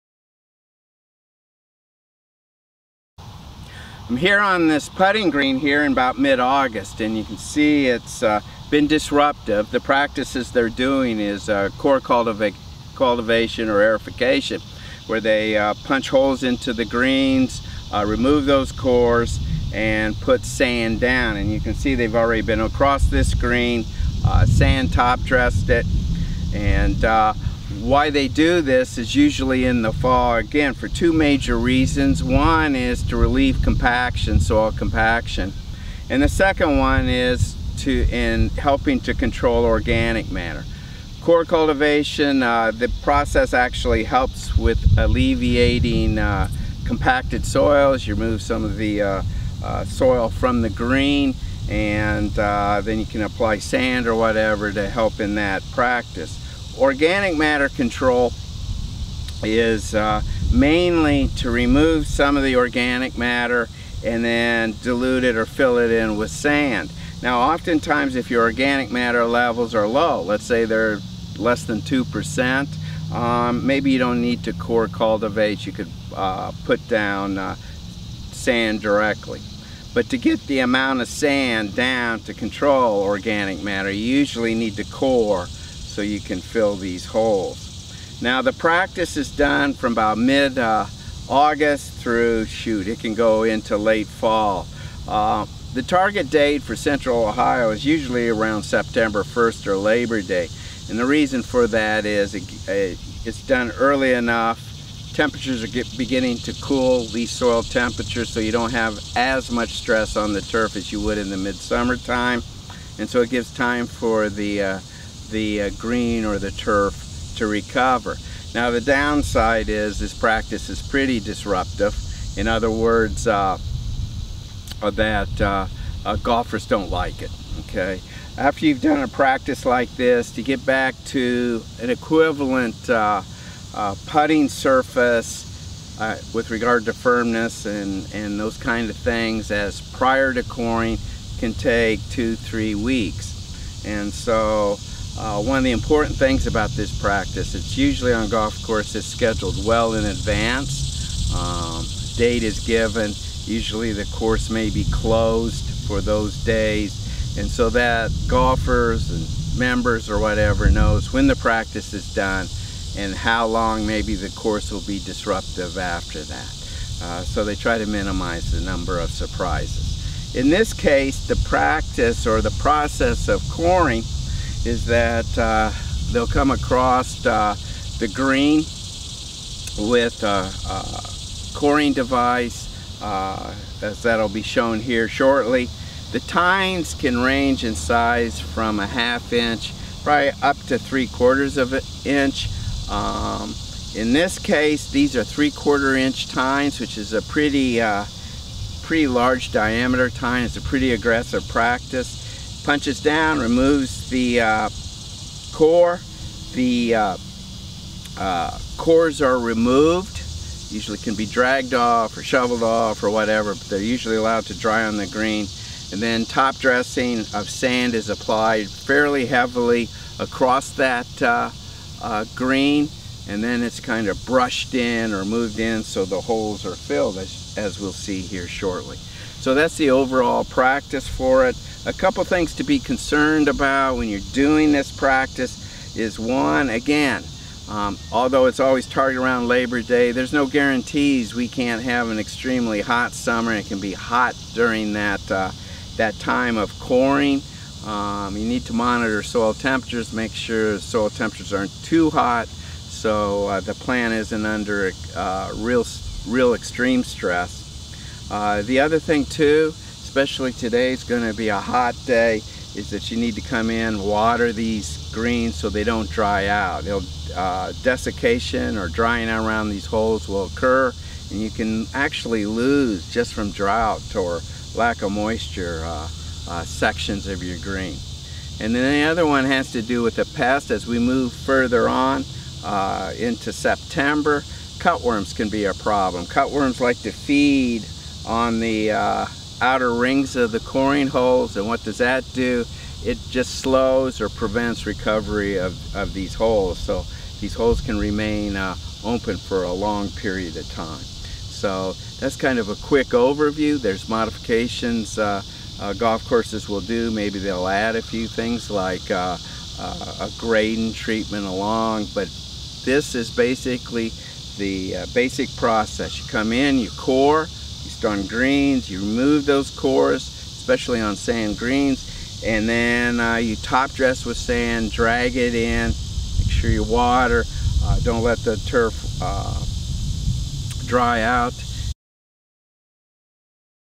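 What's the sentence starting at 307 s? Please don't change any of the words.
Maybe they'll add a few things like uh, uh, a grading treatment along, but this is basically the uh, basic process.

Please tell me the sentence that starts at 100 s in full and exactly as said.
And the reason for that is it, it, it's done early enough.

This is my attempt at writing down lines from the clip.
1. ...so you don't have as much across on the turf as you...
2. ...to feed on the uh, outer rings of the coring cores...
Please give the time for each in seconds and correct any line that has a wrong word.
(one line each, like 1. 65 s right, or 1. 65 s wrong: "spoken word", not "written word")
1. 108 s wrong: "stress", not "across"
2. 287 s wrong: "holes", not "cores".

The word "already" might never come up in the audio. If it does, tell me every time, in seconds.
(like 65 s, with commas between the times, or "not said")
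22 s.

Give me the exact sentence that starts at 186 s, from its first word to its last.
The tines can range in size from a half inch probably up to three quarters of an inch.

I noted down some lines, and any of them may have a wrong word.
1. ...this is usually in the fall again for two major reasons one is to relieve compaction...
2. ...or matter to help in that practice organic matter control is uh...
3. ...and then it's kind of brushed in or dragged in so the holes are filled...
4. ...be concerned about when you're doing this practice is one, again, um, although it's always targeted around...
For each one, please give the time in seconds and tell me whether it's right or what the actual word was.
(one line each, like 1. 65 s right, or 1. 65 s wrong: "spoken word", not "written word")
1. 28 s right
2. 54 s wrong: "whatever", not "matter"
3. 223 s wrong: "moved", not "dragged"
4. 232 s right.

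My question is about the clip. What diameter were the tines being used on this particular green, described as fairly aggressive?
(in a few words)
3/4 inch.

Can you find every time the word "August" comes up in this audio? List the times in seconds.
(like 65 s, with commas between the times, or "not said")
6 s, 91 s.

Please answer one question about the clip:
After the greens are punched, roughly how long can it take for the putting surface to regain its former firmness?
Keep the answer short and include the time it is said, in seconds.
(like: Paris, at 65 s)
2 to 3 weeks, at 142 s.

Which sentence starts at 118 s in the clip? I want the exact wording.
Now the downside is this practice is pretty disruptive.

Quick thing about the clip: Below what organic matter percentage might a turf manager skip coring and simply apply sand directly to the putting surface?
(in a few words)
2%.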